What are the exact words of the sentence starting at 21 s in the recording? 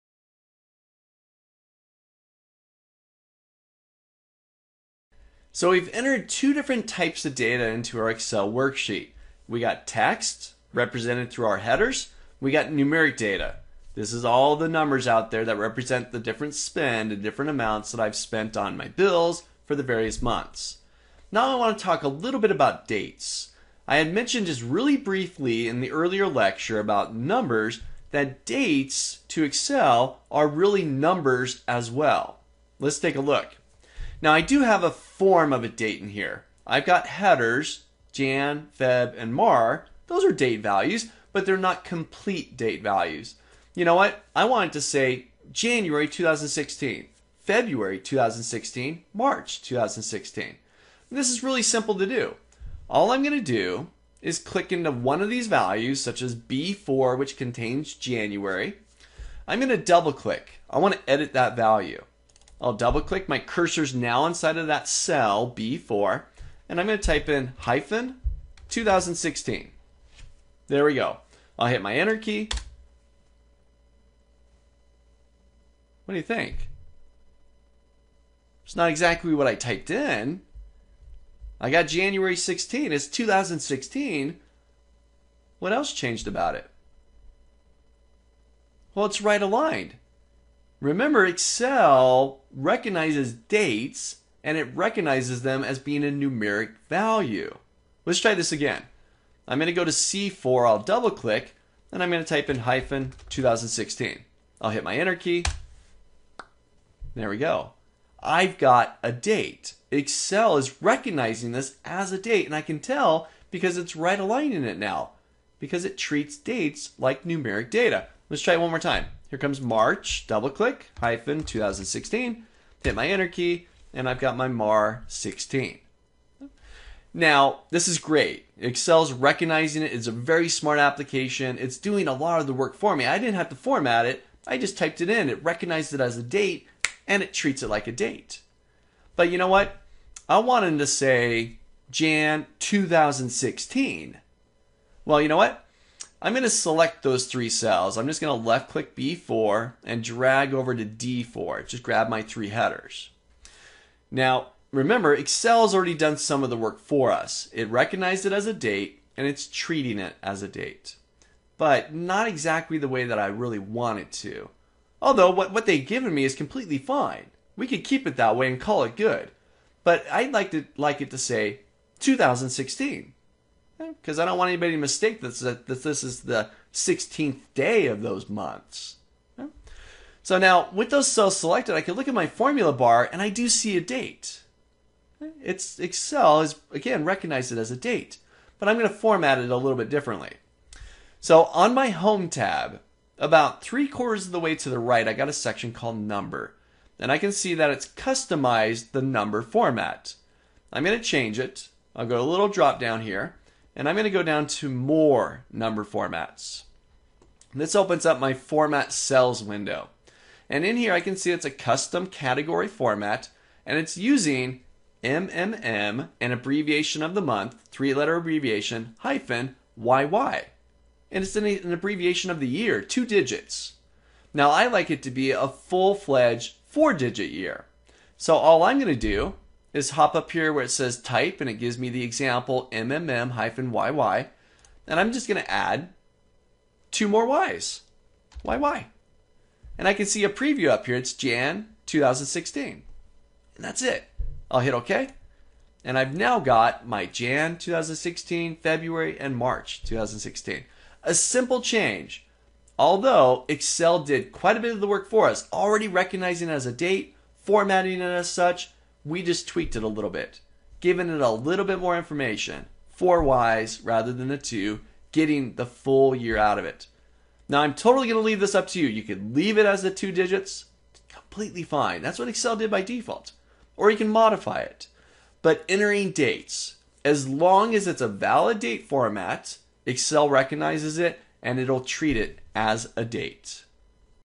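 Now I want to talk a little bit about dates.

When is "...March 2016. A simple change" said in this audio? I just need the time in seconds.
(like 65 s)
249 s.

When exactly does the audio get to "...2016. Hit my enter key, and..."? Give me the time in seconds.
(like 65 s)
121 s.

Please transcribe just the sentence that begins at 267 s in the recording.
Now, I'm totally going to leave this up to you.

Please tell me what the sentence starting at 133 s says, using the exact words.
I didn't have to format it.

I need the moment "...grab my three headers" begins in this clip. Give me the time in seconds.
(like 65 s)
151 s.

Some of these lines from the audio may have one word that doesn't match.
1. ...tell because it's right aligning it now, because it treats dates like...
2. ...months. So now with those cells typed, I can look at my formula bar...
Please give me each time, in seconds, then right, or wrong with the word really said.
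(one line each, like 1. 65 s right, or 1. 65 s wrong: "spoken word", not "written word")
1. 112 s right
2. 178 s wrong: "selected", not "typed".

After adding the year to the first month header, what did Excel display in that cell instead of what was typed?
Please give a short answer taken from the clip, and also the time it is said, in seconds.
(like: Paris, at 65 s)
January 16, at 81 s.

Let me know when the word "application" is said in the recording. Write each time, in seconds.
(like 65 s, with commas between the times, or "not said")
130 s.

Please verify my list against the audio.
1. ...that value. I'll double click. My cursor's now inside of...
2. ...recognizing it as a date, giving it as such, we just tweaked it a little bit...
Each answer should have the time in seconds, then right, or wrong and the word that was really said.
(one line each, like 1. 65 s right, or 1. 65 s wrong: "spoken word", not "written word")
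1. 61 s right
2. 255 s wrong: "formatting", not "giving".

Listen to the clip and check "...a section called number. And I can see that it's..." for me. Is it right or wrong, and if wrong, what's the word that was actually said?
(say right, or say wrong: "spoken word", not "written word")
right.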